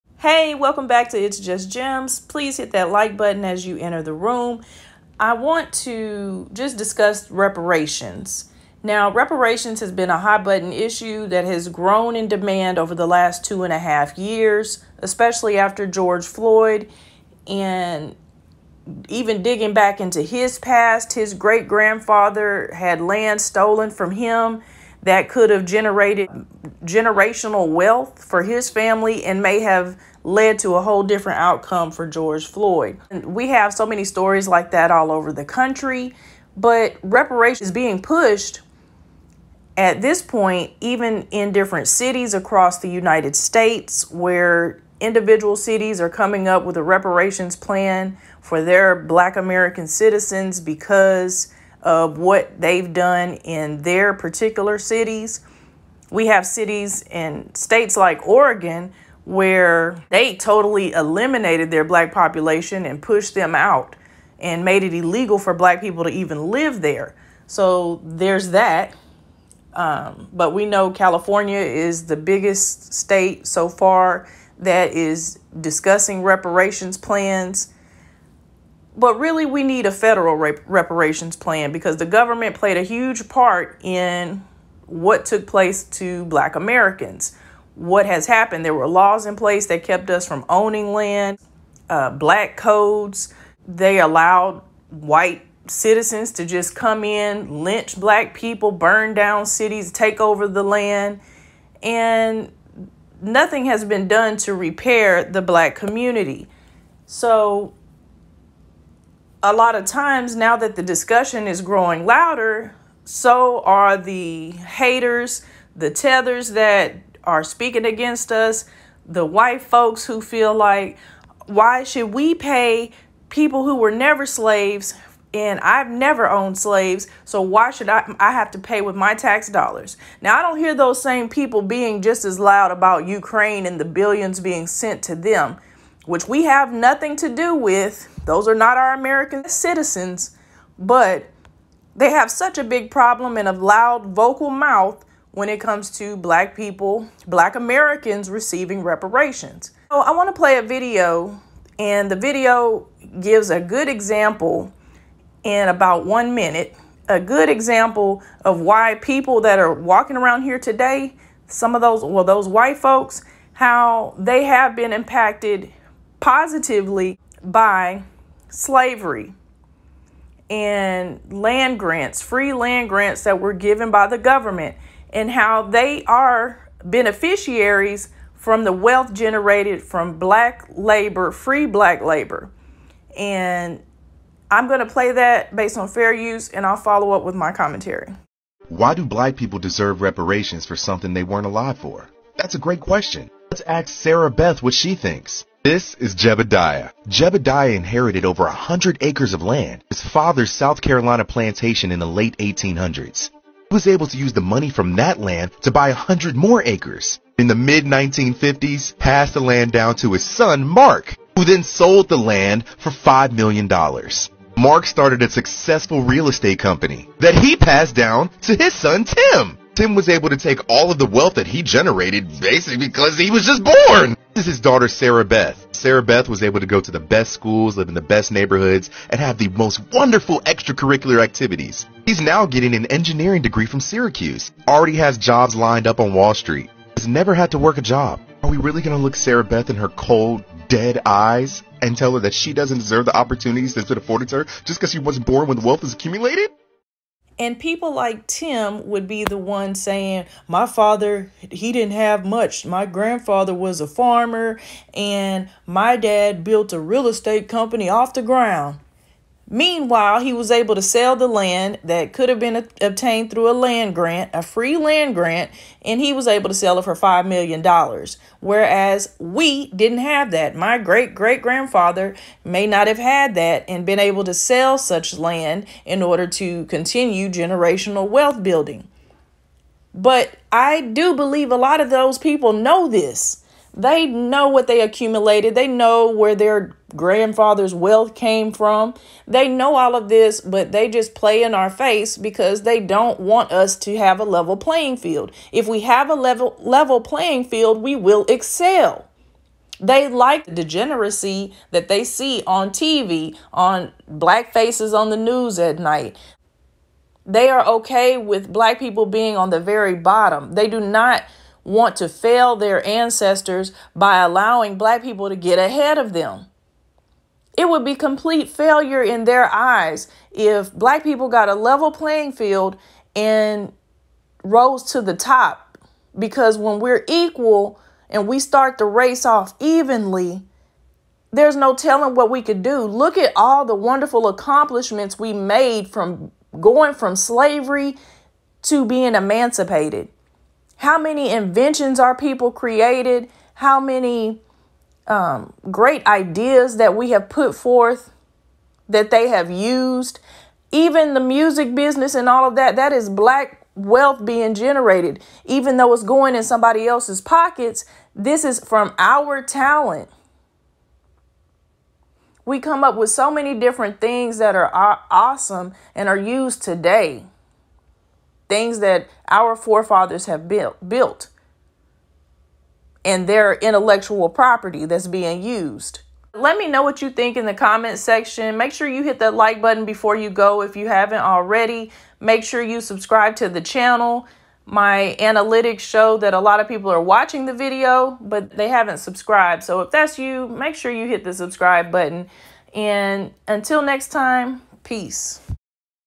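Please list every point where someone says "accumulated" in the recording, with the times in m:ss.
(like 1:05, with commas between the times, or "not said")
4:05, 4:44.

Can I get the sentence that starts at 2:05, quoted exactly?
And I've never owned slaves, so why should I, I have to pay with my tax dollars?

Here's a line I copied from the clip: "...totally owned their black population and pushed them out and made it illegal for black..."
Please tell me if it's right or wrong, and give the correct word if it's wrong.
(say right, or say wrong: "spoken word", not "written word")
wrong: "eliminated", not "owned".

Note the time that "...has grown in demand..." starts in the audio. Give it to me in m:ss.
0:11.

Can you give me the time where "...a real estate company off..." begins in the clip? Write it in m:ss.
4:16.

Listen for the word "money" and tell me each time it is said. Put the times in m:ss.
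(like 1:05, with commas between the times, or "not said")
3:24.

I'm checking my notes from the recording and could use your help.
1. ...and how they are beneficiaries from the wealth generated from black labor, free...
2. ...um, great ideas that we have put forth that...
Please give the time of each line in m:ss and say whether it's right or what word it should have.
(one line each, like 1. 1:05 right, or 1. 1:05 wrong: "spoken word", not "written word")
1. 2:55 right
2. 5:45 right.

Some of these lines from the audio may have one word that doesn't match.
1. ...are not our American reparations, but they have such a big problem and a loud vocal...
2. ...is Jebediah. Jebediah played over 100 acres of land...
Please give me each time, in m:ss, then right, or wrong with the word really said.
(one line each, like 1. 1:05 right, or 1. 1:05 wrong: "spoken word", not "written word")
1. 2:18 wrong: "citizens", not "reparations"
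2. 3:15 wrong: "inherited", not "played".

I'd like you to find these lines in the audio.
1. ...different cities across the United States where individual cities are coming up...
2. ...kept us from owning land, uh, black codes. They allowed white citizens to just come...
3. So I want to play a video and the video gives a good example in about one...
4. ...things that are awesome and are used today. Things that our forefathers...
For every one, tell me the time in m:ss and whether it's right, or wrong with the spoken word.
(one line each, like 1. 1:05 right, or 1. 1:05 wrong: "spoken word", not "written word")
1. 0:41 right
2. 1:29 right
3. 2:29 right
4. 6:03 right.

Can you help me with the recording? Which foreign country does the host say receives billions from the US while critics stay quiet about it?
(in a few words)
Ukraine.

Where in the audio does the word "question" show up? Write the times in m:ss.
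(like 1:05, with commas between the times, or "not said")
3:12.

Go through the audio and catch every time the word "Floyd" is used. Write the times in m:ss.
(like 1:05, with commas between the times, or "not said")
0:16, 0:32.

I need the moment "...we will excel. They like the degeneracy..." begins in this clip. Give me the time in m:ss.
4:57.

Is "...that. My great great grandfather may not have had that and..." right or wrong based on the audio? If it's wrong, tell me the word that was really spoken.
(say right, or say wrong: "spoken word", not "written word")
right.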